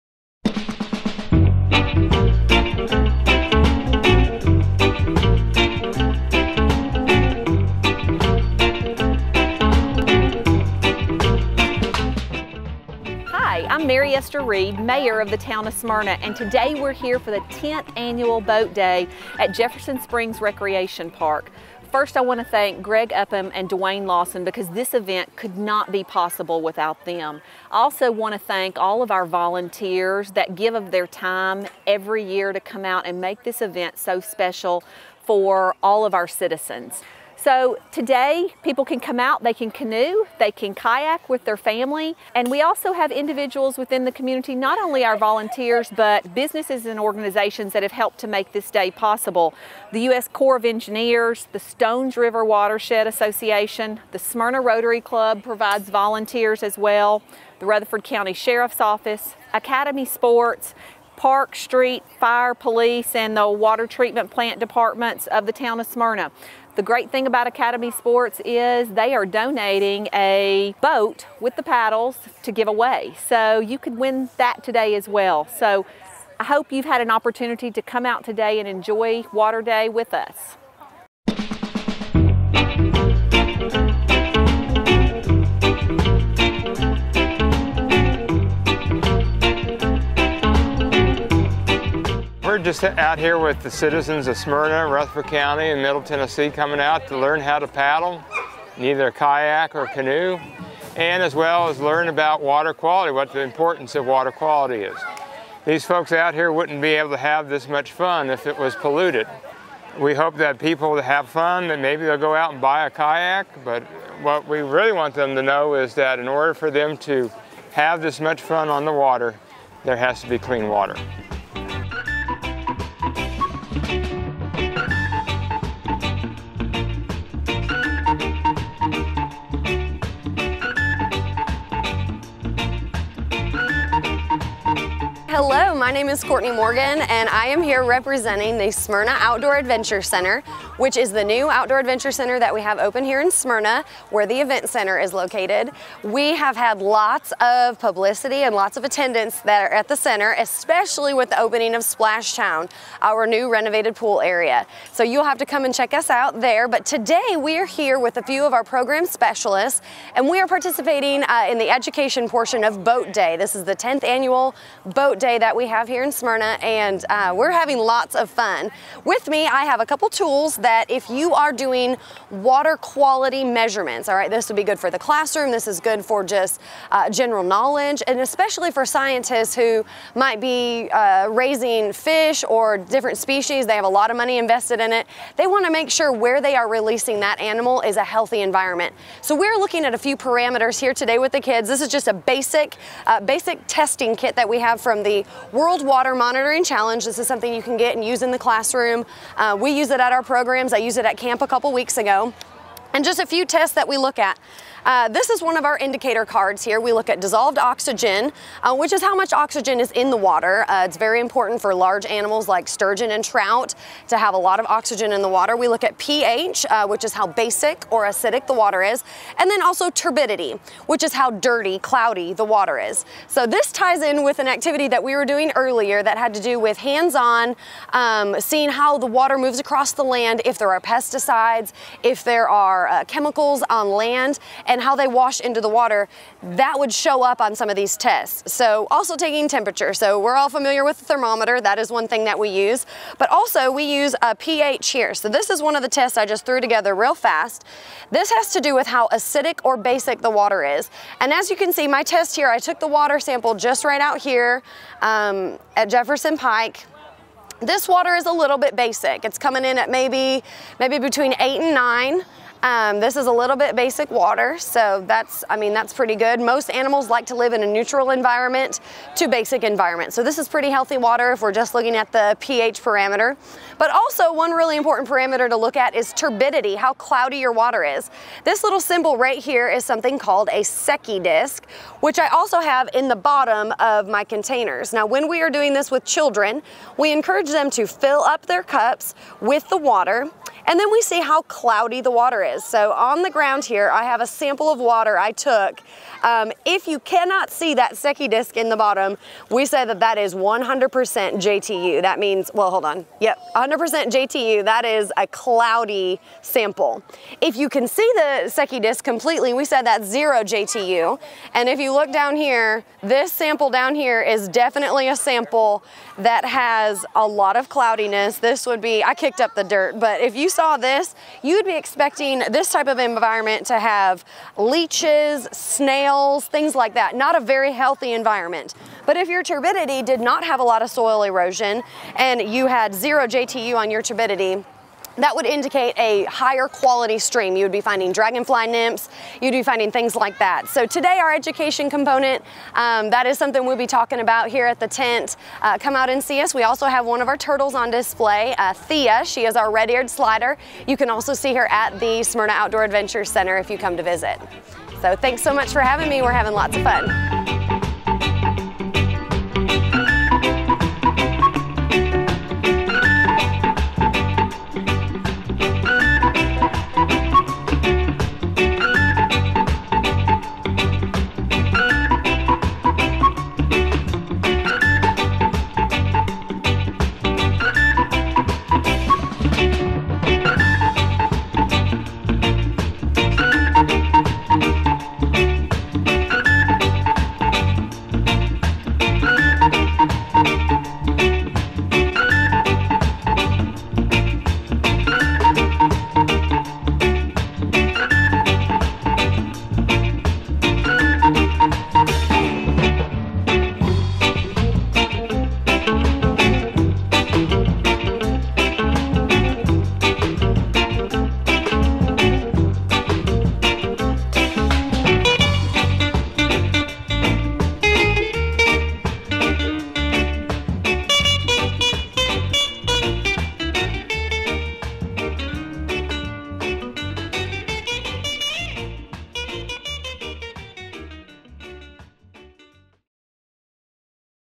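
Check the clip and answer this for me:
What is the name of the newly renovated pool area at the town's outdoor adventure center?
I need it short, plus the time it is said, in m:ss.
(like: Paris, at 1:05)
Splash Town, at 2:31.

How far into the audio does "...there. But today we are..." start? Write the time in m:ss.
2:36.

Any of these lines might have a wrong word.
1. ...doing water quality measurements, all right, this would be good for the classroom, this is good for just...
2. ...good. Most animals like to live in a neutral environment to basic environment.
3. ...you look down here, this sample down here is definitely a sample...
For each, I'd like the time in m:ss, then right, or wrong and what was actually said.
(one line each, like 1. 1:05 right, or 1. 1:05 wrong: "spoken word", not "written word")
1. 2:51 right
2. 4:26 right
3. 5:11 right.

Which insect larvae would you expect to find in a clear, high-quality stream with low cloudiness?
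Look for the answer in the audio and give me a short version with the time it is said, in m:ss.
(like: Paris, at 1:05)
dragonfly nymphs, at 5:38.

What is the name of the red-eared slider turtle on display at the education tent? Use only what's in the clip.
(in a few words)
Thea.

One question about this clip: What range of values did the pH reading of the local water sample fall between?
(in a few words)
8 to 9.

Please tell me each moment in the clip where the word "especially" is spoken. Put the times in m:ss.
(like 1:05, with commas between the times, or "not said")
2:30, 2:58.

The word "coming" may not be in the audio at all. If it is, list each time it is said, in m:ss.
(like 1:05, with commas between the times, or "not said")
1:36, 4:19.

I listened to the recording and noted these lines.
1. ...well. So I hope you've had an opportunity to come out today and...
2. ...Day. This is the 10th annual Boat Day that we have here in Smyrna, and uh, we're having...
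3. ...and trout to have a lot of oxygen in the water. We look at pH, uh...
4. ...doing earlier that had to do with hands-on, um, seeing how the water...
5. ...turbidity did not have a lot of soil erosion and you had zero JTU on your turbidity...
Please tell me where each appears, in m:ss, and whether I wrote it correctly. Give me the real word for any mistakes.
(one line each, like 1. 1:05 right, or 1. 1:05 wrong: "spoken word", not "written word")
1. 1:15 right
2. 2:43 right
3. 3:33 right
4. 3:45 right
5. 5:29 right.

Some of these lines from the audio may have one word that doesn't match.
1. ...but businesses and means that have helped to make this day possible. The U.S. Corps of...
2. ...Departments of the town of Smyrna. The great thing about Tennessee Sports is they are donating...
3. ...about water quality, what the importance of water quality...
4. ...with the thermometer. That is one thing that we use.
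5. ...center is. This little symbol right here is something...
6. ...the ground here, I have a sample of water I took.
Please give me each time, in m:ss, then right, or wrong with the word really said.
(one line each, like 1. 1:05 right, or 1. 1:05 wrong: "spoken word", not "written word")
1. 0:45 wrong: "organizations", not "means"
2. 1:04 wrong: "Academy", not "Tennessee"
3. 1:42 right
4. 4:00 right
5. 4:37 wrong: "water", not "center"
6. 4:53 right.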